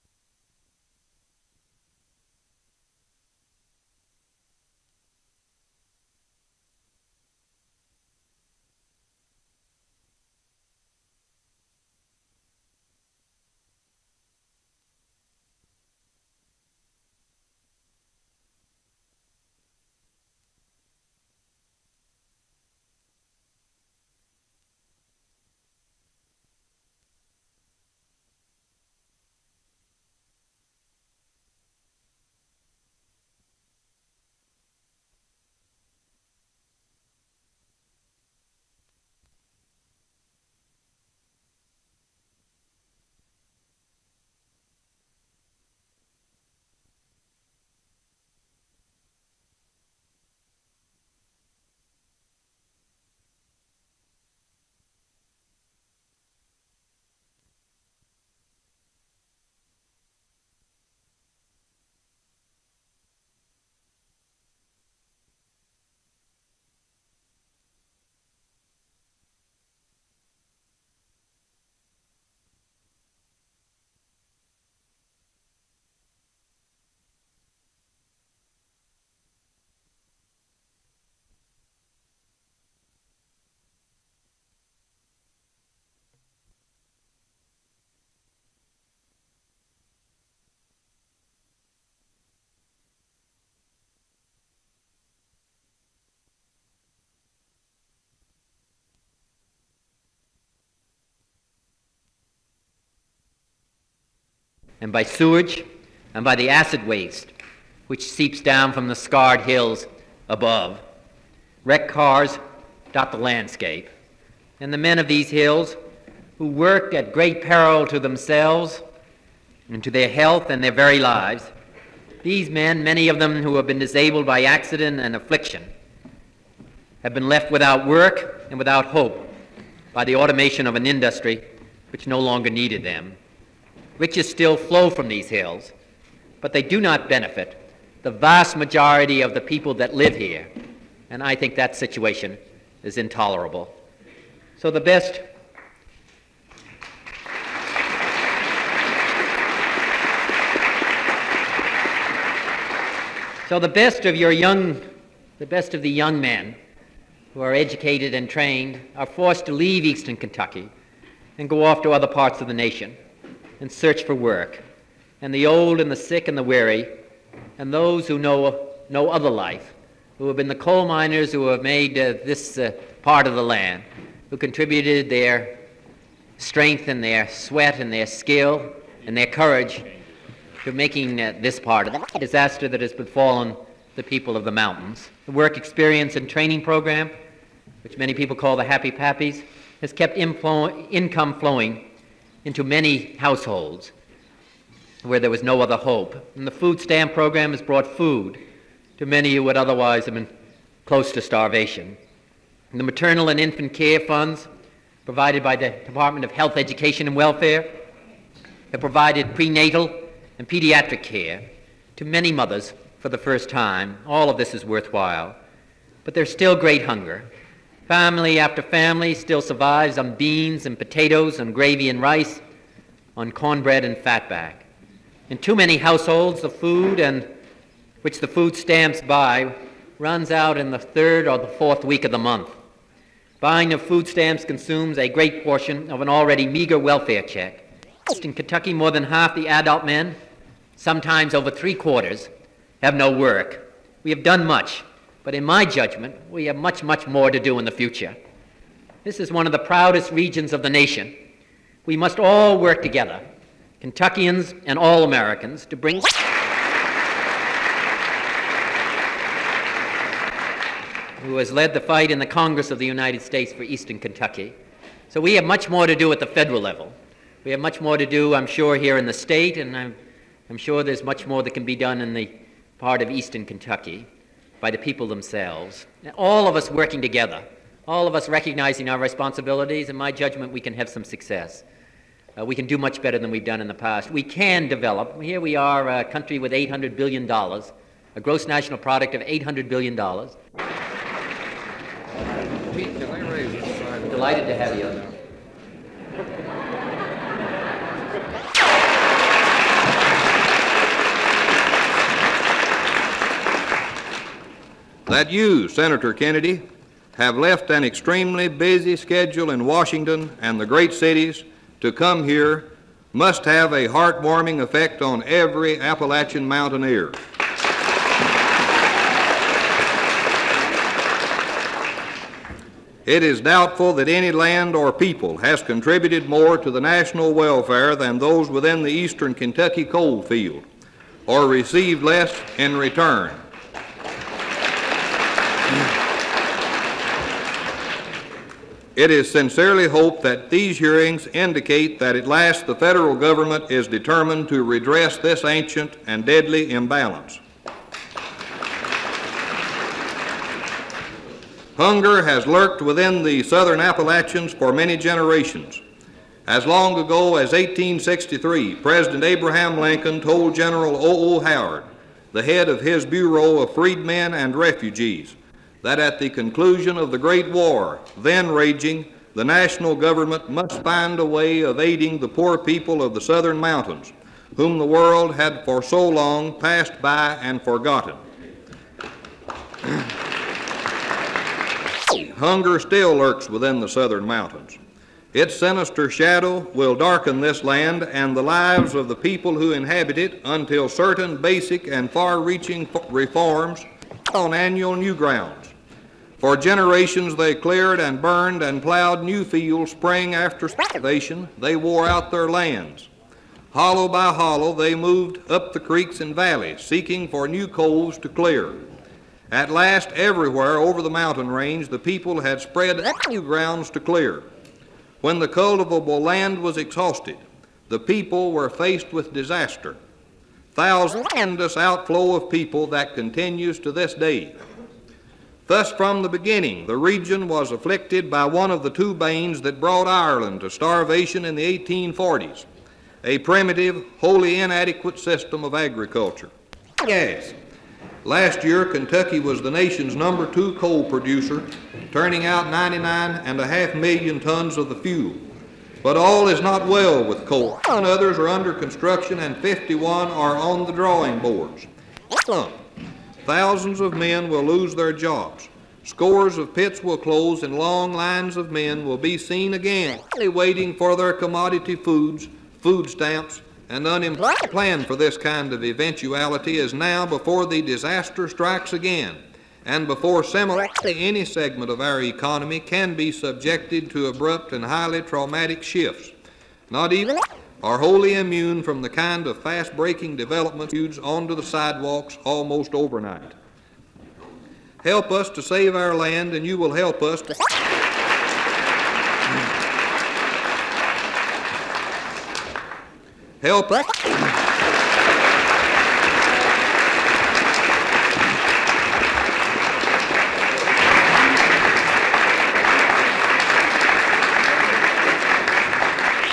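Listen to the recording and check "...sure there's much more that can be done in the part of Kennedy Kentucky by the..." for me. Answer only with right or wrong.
wrong.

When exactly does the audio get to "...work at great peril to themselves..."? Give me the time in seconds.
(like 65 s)
116 s.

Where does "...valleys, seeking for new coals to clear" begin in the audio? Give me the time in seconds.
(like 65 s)
406 s.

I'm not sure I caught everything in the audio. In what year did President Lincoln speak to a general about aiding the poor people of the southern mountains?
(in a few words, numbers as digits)
1863.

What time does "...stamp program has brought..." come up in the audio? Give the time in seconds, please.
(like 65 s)
196 s.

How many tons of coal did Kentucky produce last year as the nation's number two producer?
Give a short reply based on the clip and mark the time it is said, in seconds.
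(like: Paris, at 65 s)
99.5 million tons, at 442 s.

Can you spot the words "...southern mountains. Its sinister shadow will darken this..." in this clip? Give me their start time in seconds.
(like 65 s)
383 s.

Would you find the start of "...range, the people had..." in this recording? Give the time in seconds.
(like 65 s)
411 s.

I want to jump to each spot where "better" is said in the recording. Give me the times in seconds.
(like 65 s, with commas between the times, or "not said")
283 s.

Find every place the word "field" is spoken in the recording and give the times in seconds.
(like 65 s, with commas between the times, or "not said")
330 s, 399 s.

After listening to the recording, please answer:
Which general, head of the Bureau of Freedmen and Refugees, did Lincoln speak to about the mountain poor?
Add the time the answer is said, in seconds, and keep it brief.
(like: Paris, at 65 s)
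O. O. Howard, at 360 s.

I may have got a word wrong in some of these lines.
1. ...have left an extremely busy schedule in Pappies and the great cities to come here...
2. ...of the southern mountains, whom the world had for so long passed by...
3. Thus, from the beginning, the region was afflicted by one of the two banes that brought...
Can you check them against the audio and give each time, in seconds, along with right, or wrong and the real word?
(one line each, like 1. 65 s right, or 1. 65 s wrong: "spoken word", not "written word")
1. 307 s wrong: "Washington", not "Pappies"
2. 373 s right
3. 425 s right.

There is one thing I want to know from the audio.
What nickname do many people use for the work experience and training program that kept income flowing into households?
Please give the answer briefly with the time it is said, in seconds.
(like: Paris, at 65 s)
Happy Pappies, at 188 s.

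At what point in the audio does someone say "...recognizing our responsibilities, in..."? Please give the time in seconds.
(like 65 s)
278 s.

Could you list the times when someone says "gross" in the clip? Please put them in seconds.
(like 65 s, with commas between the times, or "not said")
288 s.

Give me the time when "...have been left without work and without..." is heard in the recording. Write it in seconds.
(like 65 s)
127 s.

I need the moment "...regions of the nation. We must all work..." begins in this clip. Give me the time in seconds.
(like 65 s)
250 s.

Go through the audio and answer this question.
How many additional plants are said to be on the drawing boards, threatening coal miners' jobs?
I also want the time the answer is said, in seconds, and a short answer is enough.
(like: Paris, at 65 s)
51, at 449 s.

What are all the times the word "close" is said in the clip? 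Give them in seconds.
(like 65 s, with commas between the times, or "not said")
200 s, 457 s.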